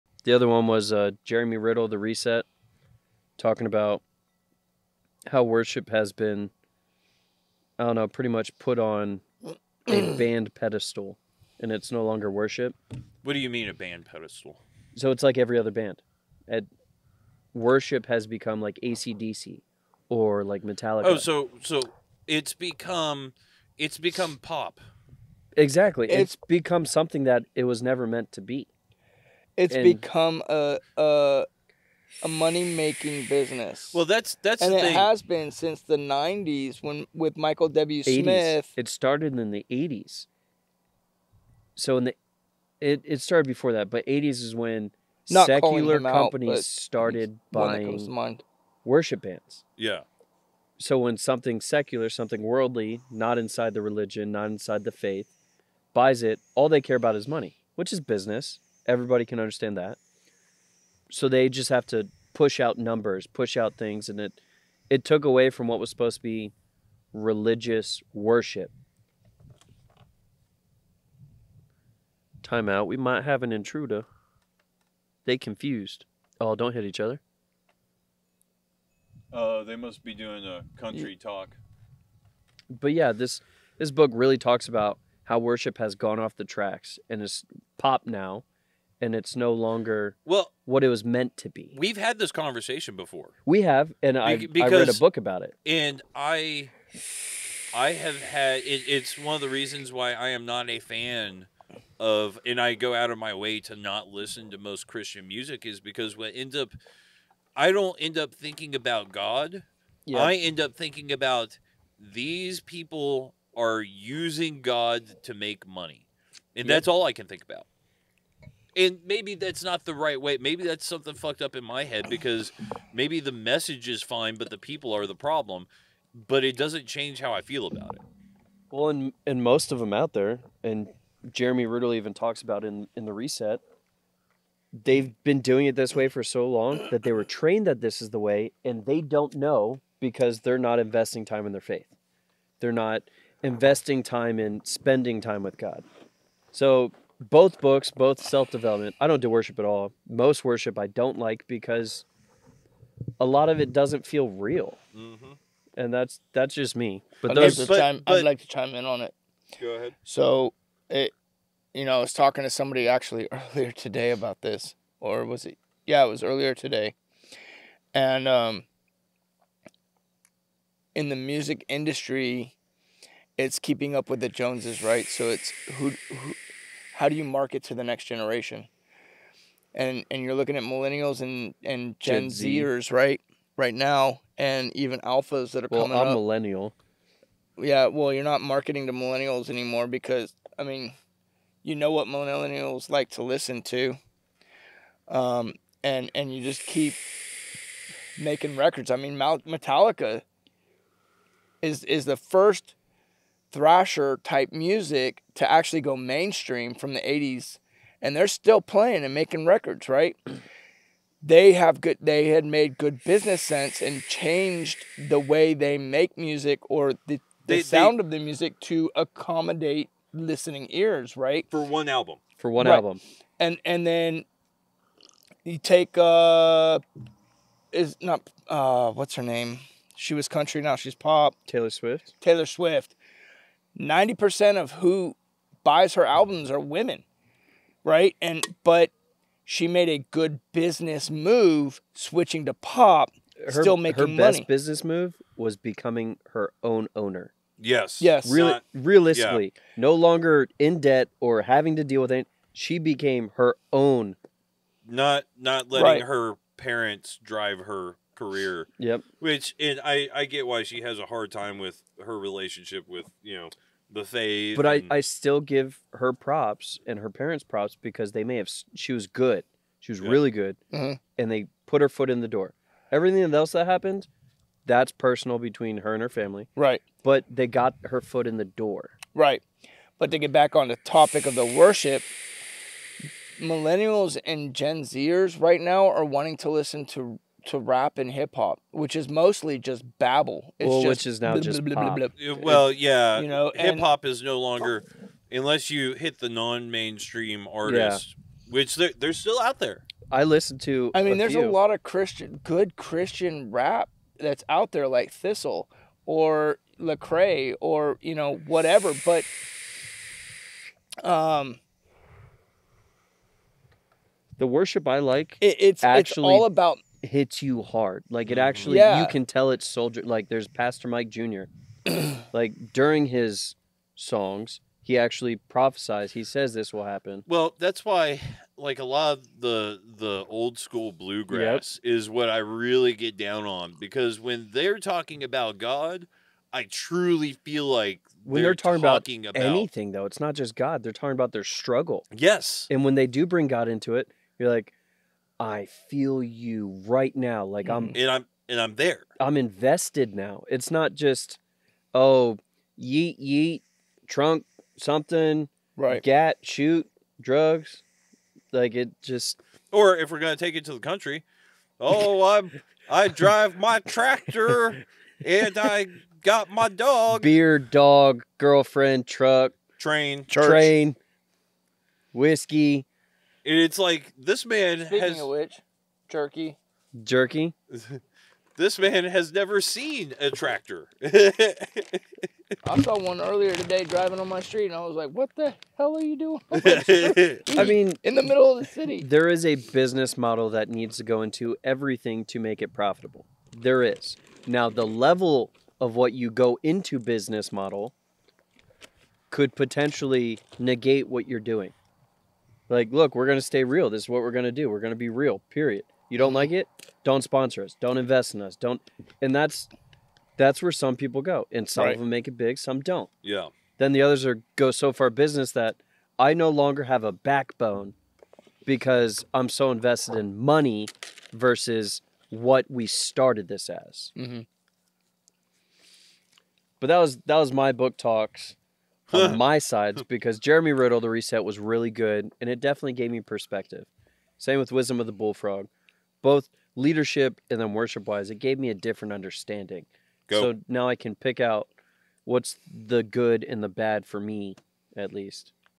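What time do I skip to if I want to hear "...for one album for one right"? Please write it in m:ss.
3:41.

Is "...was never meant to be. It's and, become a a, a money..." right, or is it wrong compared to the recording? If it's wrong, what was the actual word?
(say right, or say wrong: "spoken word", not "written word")
right.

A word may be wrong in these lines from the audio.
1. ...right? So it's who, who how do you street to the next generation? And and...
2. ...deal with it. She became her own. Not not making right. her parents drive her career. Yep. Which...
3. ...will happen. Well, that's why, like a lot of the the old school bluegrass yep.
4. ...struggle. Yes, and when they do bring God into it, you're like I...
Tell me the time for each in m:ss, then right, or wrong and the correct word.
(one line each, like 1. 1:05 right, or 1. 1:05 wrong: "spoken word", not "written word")
1. 2:54 wrong: "market", not "street"
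2. 4:11 wrong: "letting", not "making"
3. 5:26 right
4. 5:41 right.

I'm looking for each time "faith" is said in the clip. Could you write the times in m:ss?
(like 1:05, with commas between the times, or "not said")
0:54, 2:21, 4:24.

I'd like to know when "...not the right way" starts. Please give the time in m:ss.
1:59.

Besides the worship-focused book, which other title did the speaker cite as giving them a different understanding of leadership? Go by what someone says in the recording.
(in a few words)
Wisdom of the Bullfrog.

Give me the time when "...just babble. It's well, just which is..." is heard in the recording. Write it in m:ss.
4:49.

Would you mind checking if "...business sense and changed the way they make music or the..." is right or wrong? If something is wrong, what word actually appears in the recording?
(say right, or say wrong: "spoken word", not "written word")
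right.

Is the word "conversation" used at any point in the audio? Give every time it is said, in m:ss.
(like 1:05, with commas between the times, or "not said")
1:32.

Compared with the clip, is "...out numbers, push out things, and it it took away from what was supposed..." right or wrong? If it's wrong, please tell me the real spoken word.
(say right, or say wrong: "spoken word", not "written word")
right.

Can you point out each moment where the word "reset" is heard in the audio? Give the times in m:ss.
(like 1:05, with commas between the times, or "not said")
0:01, 2:13, 7:11.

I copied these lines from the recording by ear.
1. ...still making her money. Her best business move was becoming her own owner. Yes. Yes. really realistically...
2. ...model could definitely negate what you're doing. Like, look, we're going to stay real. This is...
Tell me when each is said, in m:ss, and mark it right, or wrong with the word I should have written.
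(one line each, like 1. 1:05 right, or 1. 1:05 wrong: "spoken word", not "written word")
1. 4:03 right
2. 6:37 wrong: "potentially", not "definitely".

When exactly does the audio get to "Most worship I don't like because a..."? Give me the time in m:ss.
2:30.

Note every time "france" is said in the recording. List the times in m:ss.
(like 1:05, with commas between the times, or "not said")
not said.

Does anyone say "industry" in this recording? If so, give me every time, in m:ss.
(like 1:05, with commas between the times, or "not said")
2:51.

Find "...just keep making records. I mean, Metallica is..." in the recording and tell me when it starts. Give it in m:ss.
3:16.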